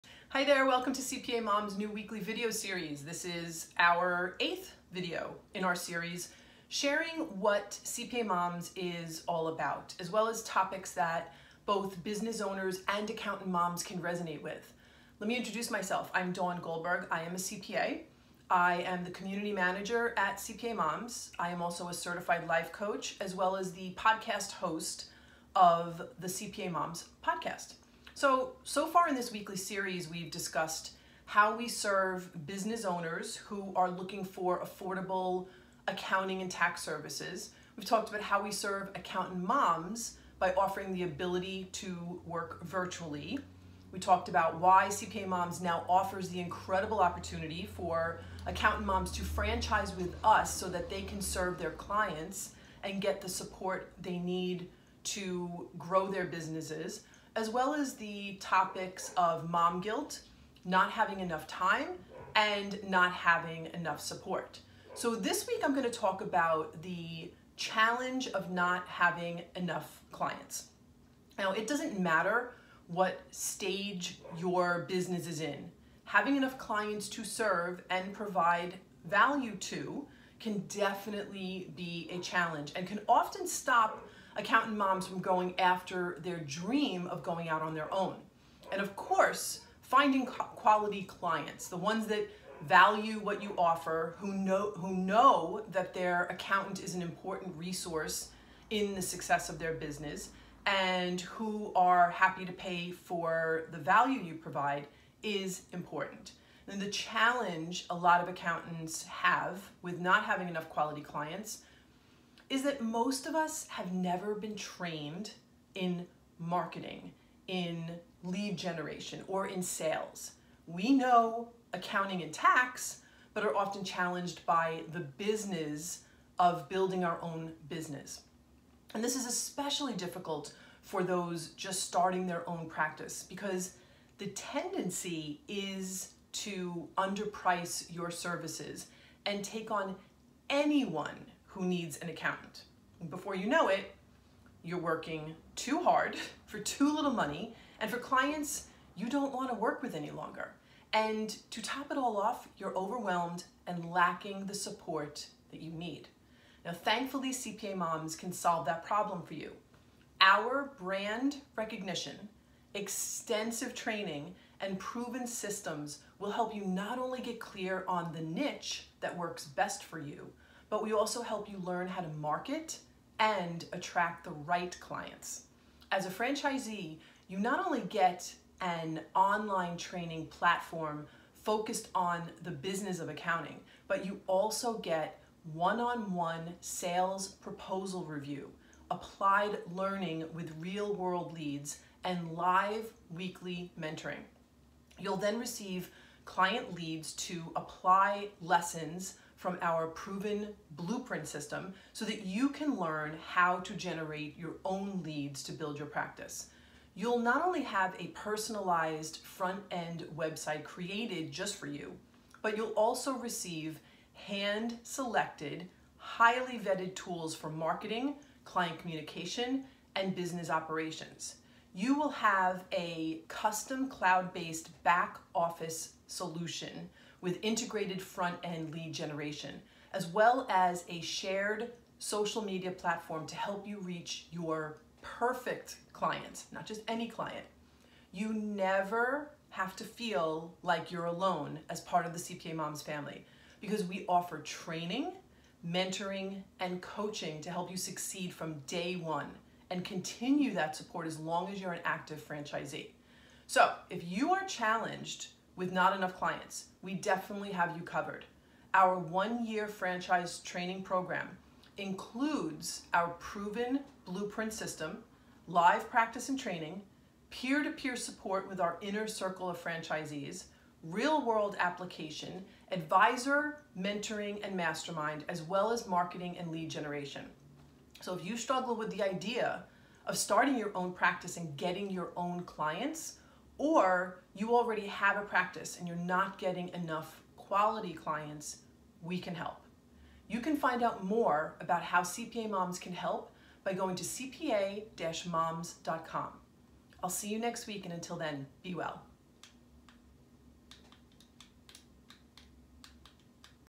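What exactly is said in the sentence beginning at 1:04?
So this week I'm going to talk about the challenge of not having enough clients.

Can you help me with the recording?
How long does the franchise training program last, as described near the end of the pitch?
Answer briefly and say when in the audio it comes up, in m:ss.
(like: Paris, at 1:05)
one year, at 4:18.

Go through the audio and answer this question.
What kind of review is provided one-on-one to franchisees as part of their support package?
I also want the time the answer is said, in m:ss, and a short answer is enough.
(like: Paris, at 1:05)
sales proposal review, at 3:06.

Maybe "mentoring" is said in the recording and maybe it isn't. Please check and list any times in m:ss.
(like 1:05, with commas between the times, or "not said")
3:13, 4:05, 4:33.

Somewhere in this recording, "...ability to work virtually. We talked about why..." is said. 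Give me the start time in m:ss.
0:41.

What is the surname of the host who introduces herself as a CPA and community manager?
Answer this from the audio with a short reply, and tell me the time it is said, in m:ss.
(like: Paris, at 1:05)
Goldberg, at 0:16.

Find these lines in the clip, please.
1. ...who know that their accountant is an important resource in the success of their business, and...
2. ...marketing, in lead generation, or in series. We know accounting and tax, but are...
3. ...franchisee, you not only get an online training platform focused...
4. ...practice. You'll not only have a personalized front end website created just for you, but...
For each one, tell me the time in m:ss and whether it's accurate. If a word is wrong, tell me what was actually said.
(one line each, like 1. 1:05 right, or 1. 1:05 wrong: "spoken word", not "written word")
1. 1:34 right
2. 1:56 wrong: "sales", not "series"
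3. 2:56 right
4. 3:25 right.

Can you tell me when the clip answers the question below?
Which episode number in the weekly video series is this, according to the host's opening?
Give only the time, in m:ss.
0:04.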